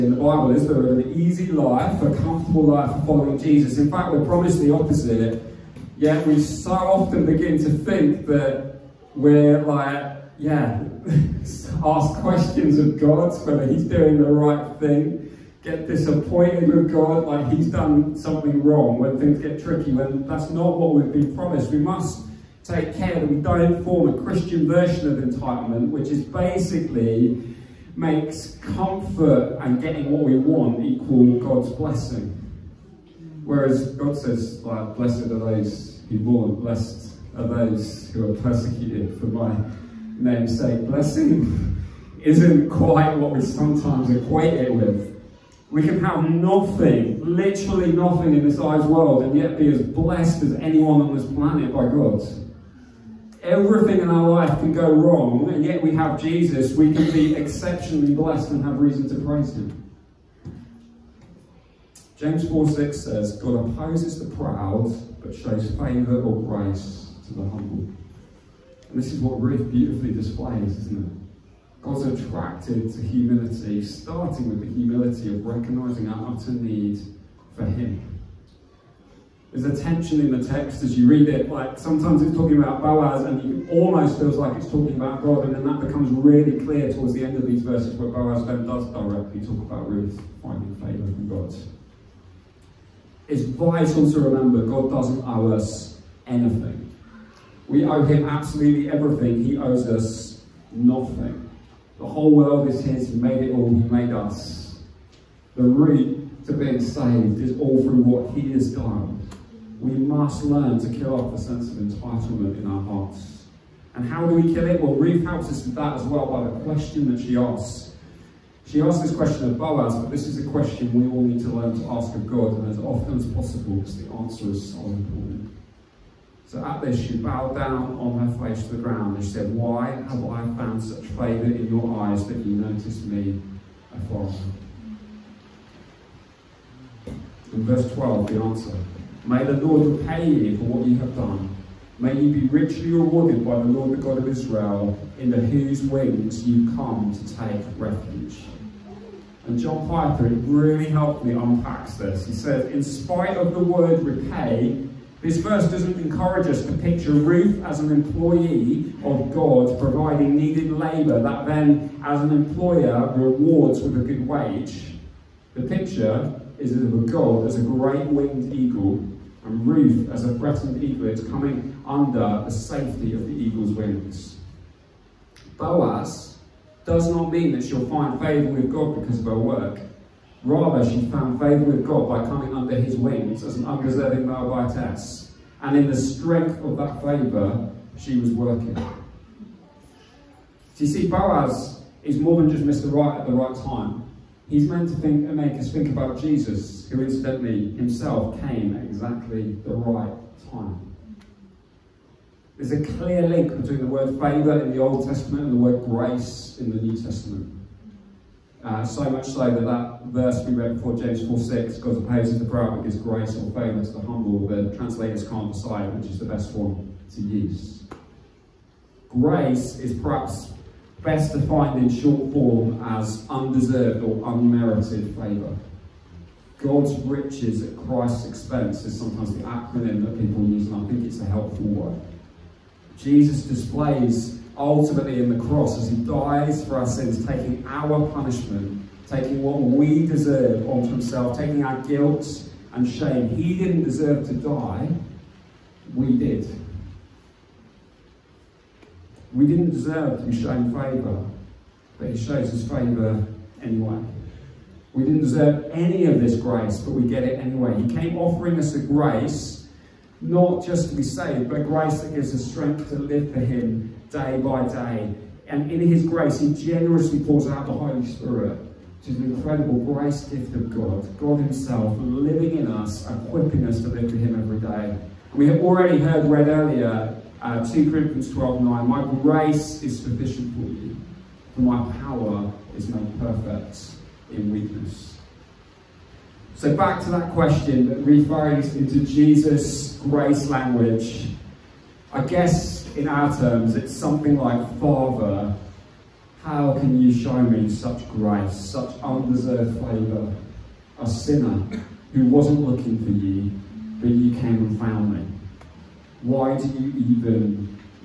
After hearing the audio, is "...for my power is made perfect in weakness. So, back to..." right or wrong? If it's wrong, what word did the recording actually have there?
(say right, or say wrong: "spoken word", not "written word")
right.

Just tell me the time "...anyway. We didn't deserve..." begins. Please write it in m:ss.
4:13.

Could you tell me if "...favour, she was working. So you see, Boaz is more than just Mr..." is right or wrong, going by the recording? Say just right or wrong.
right.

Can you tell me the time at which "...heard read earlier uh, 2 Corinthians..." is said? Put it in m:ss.
4:35.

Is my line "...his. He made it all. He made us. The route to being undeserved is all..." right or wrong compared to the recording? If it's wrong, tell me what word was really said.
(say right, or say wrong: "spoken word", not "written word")
wrong: "saved", not "undeserved".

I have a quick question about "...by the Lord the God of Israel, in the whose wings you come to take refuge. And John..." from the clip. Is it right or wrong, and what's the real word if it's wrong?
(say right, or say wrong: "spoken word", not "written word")
right.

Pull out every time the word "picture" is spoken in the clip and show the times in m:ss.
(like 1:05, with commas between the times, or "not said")
2:36, 2:45.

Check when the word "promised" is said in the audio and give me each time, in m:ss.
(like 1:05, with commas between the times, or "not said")
0:04, 0:21.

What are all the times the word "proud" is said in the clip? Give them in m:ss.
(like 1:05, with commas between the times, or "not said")
1:04, 3:32.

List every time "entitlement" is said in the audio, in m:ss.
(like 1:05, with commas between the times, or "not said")
0:25, 1:51.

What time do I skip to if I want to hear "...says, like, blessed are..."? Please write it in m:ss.
0:34.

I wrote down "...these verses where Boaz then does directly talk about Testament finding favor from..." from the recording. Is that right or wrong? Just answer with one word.
wrong.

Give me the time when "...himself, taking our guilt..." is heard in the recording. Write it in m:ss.
4:00.